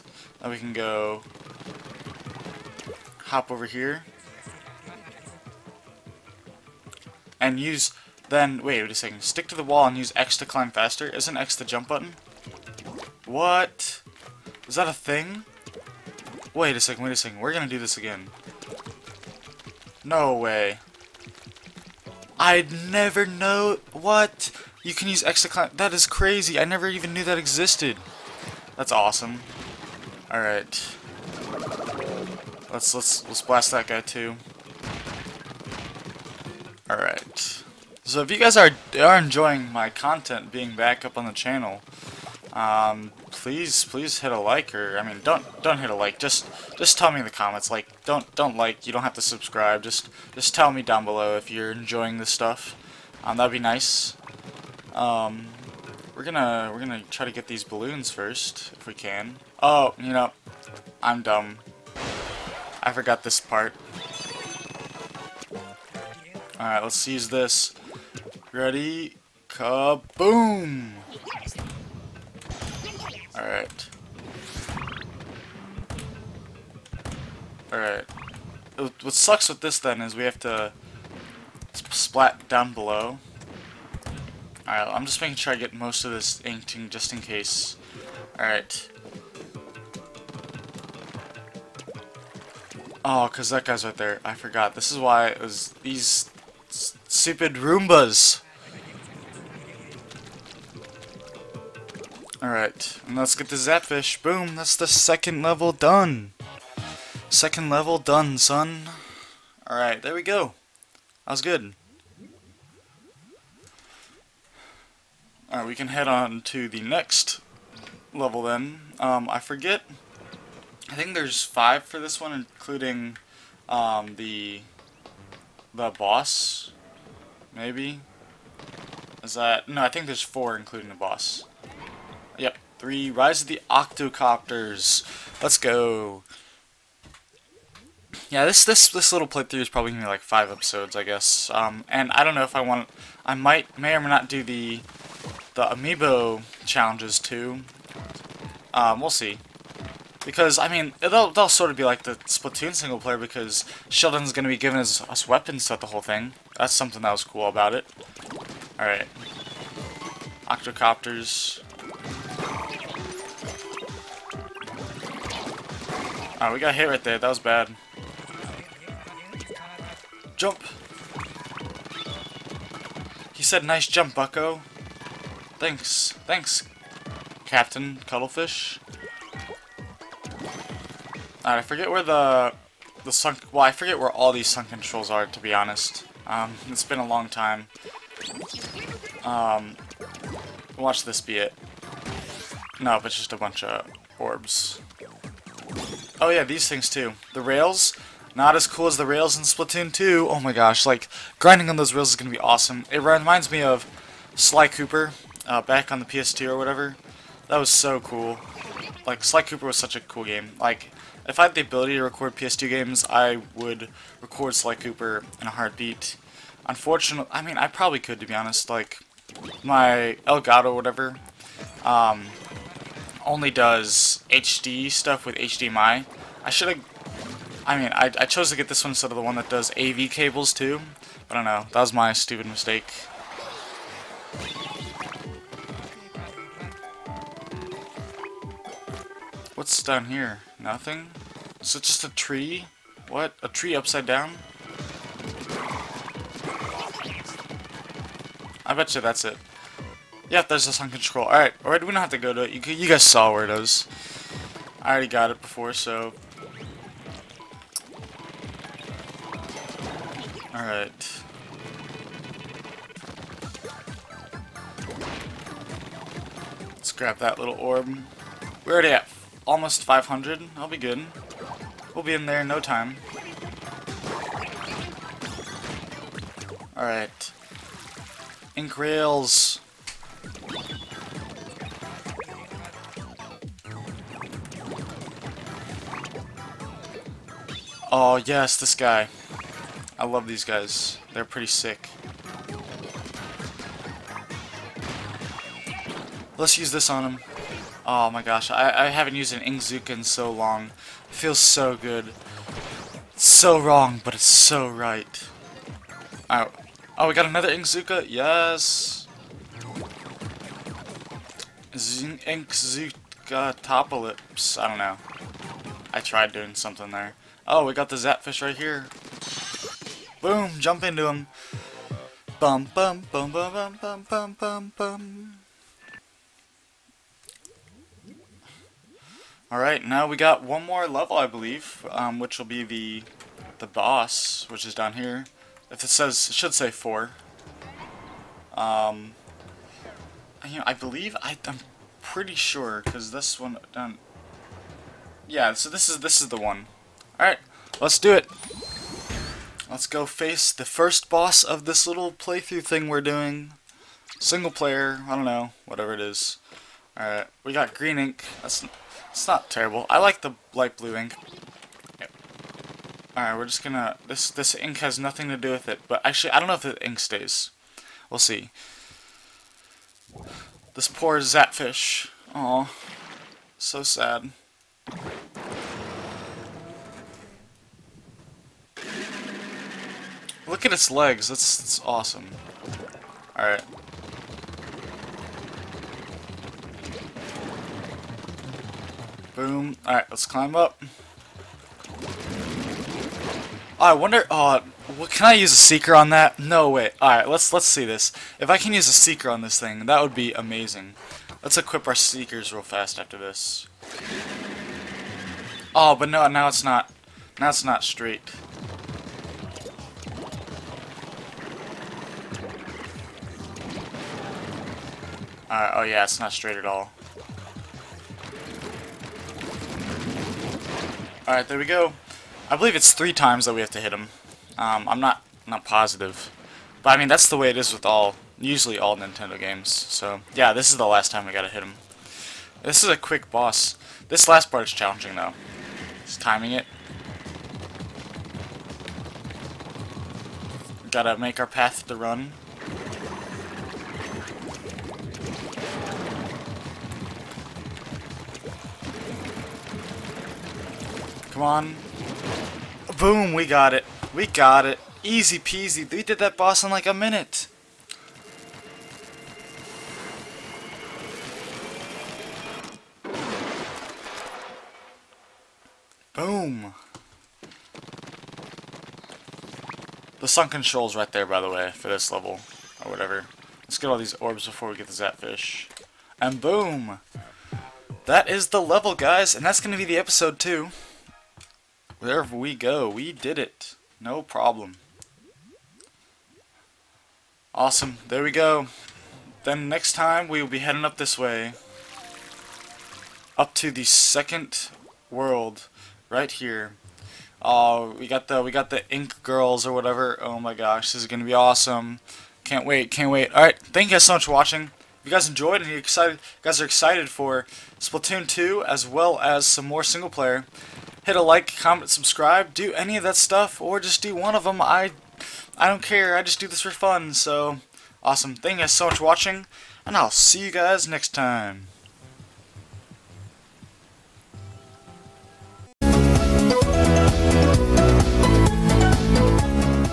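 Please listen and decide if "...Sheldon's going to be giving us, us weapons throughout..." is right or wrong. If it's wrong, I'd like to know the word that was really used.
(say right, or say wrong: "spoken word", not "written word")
right.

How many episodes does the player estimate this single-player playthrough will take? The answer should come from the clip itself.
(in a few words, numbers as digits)
5.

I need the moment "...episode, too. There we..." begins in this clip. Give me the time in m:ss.
7:59.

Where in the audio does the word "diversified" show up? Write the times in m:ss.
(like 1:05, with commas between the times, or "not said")
not said.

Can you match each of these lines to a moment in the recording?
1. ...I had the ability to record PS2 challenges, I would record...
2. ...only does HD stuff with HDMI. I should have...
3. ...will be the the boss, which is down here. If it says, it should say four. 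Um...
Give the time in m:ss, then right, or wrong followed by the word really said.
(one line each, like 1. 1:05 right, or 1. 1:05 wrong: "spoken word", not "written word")
1. 3:31 wrong: "games", not "challenges"
2. 3:43 right
3. 5:32 right.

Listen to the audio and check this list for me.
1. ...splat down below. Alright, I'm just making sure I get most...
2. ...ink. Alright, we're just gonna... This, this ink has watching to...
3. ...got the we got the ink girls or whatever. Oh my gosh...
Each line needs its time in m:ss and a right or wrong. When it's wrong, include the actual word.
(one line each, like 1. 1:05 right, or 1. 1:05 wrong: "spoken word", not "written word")
1. 1:21 right
2. 6:00 wrong: "nothing", not "watching"
3. 8:18 right.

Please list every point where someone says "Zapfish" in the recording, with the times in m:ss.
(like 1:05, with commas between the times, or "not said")
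1:43, 5:17, 6:11, 7:54.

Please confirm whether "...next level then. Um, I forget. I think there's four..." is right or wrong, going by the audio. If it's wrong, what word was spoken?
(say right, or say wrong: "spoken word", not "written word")
wrong: "five", not "four".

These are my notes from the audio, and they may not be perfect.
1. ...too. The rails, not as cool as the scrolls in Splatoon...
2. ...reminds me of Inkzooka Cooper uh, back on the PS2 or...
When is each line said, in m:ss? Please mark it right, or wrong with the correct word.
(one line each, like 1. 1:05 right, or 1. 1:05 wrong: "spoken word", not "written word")
1. 3:16 wrong: "rails", not "scrolls"
2. 3:23 wrong: "Sly", not "Inkzooka".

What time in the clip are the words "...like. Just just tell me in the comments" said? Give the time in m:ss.
0:45.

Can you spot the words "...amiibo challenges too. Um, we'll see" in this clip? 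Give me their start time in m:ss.
2:25.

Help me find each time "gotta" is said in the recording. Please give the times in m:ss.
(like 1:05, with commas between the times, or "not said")
7:11, 7:20.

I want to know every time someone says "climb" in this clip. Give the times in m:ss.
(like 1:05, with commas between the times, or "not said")
0:10, 0:25, 6:30.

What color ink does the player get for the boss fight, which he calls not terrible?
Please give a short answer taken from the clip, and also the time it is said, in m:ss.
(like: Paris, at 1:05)
Green, at 5:57.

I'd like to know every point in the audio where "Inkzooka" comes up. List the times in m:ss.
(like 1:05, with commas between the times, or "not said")
4:59, 5:07, 5:11.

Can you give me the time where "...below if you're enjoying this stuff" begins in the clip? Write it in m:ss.
0:51.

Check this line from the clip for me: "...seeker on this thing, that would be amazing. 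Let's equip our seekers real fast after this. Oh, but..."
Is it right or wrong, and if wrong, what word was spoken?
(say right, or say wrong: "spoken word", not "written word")
right.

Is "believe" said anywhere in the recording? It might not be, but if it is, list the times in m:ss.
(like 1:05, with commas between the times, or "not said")
5:31, 5:40, 7:02.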